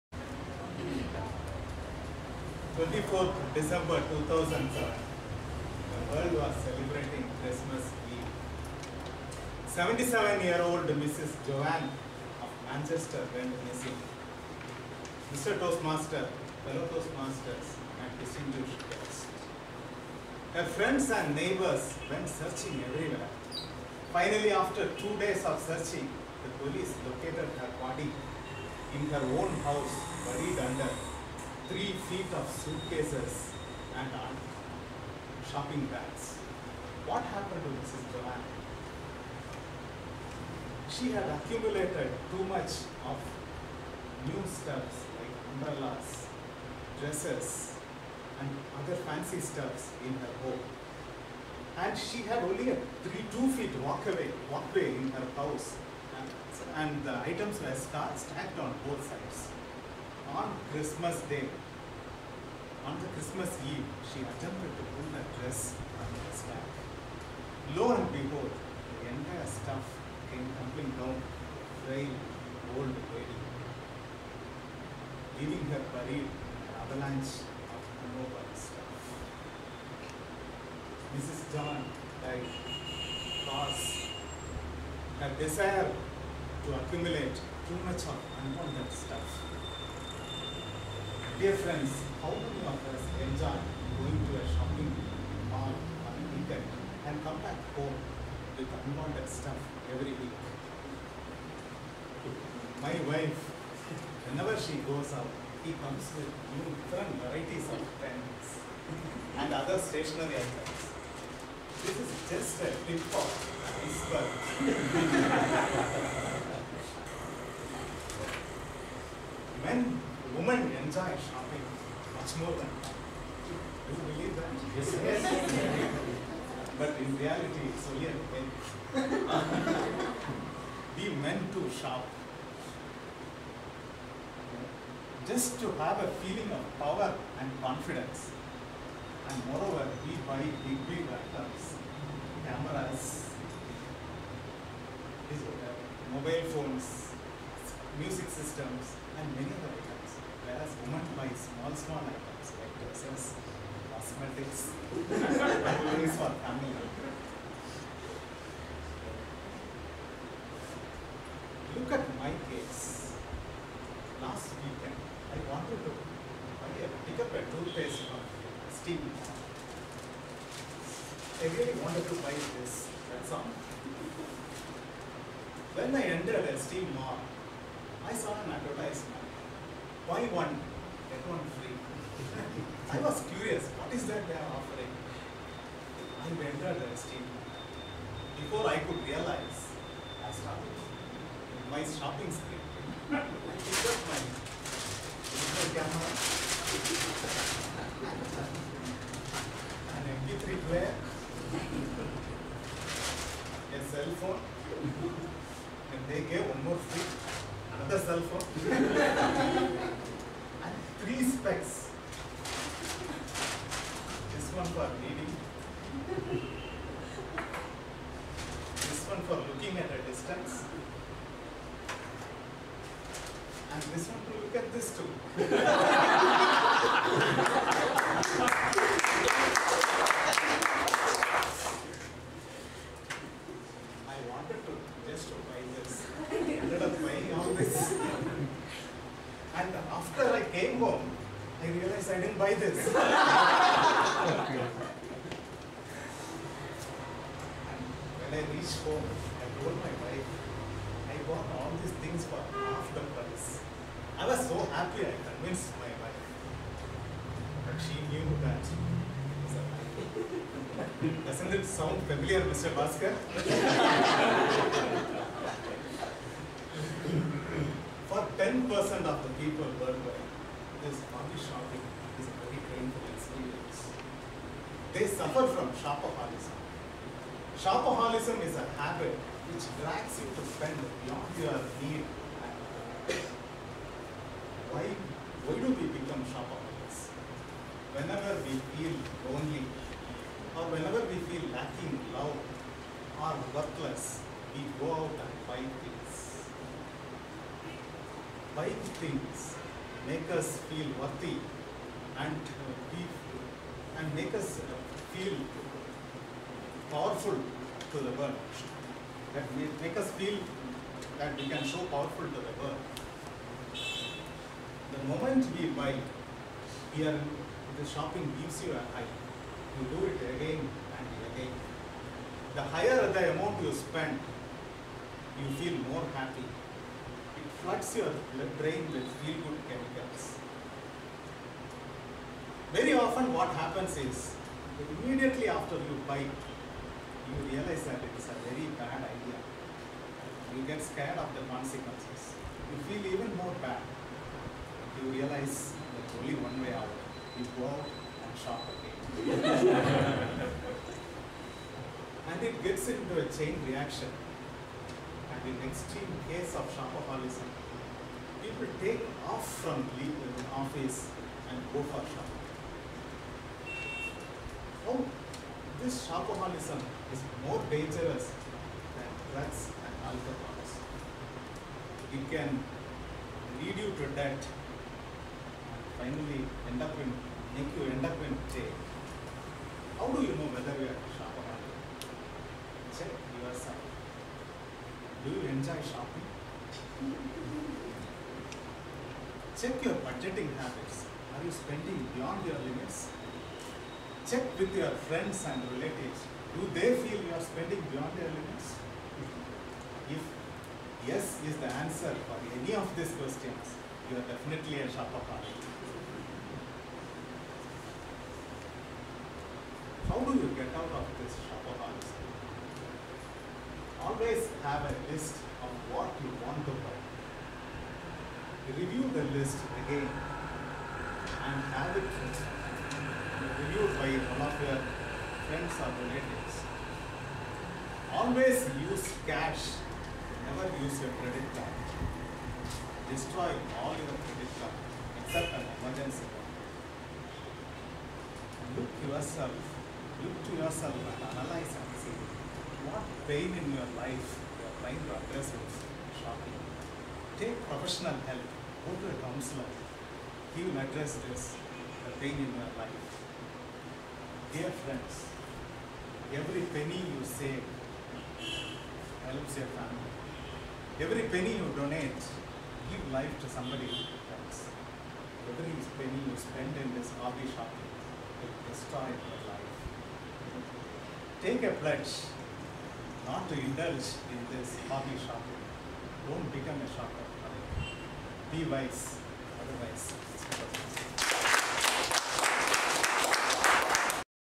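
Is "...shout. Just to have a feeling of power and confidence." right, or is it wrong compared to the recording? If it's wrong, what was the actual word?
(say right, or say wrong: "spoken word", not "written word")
right.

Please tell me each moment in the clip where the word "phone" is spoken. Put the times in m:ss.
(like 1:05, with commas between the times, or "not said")
2:26, 3:24, 3:28.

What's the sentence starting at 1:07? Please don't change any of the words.
Lo and behold, the entire stuff came tumbling down frail old lady, leaving her buried in an avalanche of immobile stuff.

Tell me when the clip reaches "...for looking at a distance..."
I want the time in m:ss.
3:39.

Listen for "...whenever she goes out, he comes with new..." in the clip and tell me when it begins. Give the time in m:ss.
1:44.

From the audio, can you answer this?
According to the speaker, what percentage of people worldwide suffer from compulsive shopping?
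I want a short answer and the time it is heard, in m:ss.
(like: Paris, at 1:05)
10%, at 4:28.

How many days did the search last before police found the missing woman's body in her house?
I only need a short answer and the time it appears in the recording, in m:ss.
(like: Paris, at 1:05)
2, at 0:24.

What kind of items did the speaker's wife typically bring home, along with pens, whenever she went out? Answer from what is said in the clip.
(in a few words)
stationery items.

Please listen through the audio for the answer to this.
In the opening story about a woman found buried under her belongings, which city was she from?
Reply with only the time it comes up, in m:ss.
0:12.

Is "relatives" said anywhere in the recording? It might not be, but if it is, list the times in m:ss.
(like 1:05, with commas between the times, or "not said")
6:35, 7:06.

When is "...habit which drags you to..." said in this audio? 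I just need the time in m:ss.
4:38.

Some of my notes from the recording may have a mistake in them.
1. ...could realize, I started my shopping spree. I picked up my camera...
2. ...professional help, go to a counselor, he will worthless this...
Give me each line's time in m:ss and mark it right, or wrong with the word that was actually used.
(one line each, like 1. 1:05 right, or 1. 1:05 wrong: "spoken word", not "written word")
1. 3:08 right
2. 7:27 wrong: "address", not "worthless".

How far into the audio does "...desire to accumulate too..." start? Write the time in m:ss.
1:25.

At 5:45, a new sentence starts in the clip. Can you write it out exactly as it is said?
You realize there's only one way out.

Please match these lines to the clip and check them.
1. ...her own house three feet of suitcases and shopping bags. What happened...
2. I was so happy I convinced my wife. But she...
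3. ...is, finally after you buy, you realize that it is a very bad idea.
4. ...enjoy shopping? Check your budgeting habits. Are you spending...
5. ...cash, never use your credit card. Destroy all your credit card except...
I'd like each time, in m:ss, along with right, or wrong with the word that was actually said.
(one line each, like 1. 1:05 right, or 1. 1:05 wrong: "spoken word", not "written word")
1. 0:29 right
2. 4:14 right
3. 5:33 wrong: "immediately", not "finally"
4. 6:25 right
5. 7:09 right.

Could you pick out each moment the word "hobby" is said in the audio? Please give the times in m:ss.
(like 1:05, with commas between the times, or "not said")
7:47, 7:54.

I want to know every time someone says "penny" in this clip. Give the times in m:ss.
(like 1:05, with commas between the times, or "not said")
7:36, 7:41, 7:45.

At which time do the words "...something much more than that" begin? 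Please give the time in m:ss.
2:01.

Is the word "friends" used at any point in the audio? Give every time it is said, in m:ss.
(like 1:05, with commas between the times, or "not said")
0:20, 1:31, 6:35, 7:05, 7:34.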